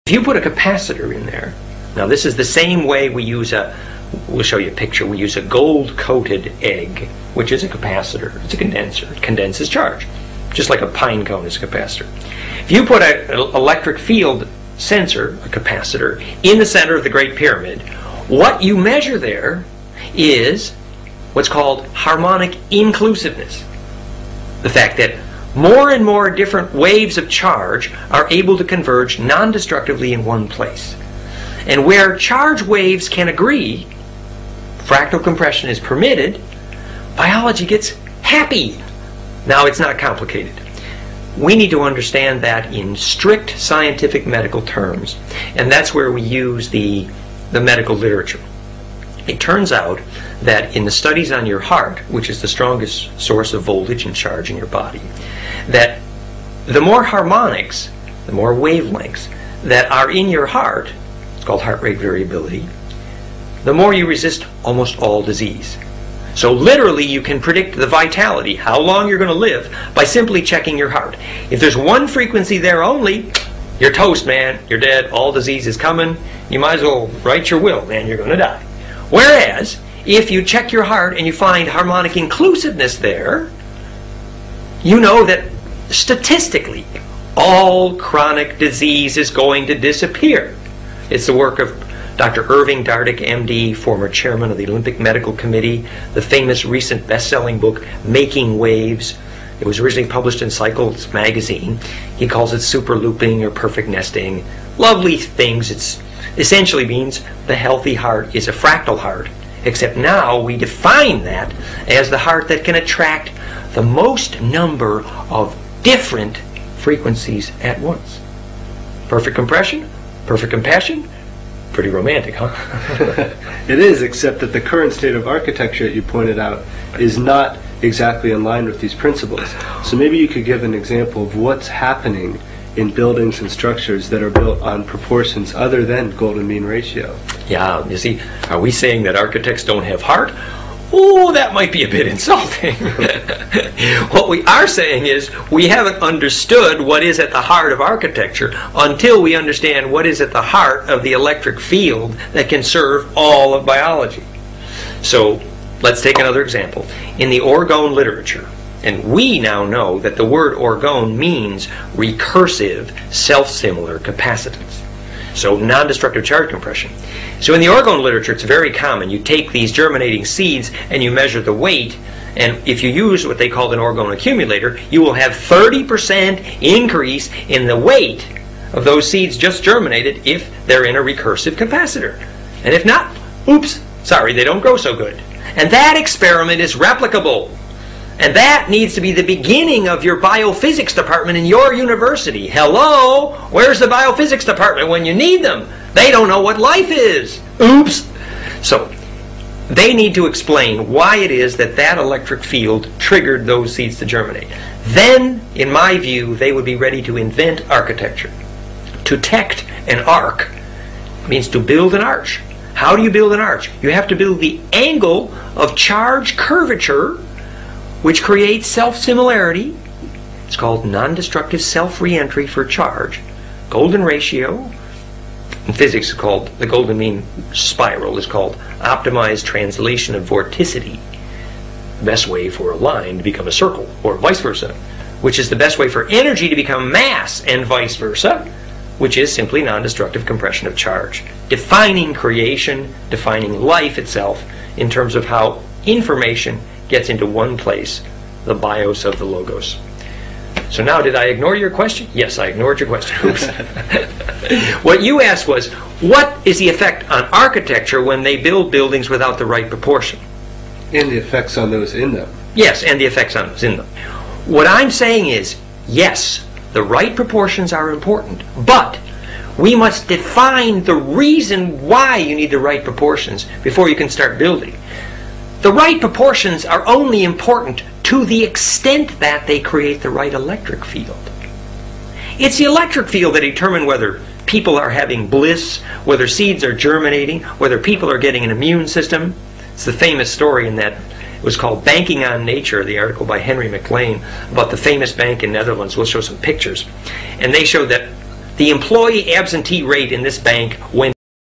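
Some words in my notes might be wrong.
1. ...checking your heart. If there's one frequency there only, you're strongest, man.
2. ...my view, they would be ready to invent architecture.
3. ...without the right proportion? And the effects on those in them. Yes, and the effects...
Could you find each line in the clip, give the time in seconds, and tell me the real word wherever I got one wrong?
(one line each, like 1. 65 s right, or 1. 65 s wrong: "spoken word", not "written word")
1. 70 s wrong: "toast", not "strongest"
2. 205 s right
3. 259 s right.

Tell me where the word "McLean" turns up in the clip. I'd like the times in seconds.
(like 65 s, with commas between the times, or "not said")
293 s.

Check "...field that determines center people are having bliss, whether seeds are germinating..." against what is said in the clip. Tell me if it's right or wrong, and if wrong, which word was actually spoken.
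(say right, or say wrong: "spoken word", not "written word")
wrong: "whether", not "center".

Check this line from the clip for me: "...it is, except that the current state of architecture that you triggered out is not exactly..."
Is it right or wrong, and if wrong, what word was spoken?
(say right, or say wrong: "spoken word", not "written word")
wrong: "pointed", not "triggered".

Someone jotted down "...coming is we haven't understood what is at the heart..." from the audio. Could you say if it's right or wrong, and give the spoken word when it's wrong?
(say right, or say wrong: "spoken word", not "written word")
wrong: "saying", not "coming".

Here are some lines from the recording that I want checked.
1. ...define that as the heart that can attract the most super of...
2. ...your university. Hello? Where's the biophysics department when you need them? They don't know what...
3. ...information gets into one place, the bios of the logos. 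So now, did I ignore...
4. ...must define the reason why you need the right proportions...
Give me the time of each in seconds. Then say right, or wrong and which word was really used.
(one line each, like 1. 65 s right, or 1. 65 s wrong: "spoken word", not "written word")
1. 110 s wrong: "number", not "super"
2. 191 s right
3. 245 s right
4. 269 s right.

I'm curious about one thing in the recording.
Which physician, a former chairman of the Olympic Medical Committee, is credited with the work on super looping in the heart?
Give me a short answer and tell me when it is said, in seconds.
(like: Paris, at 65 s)
Irving Dardick, at 92 s.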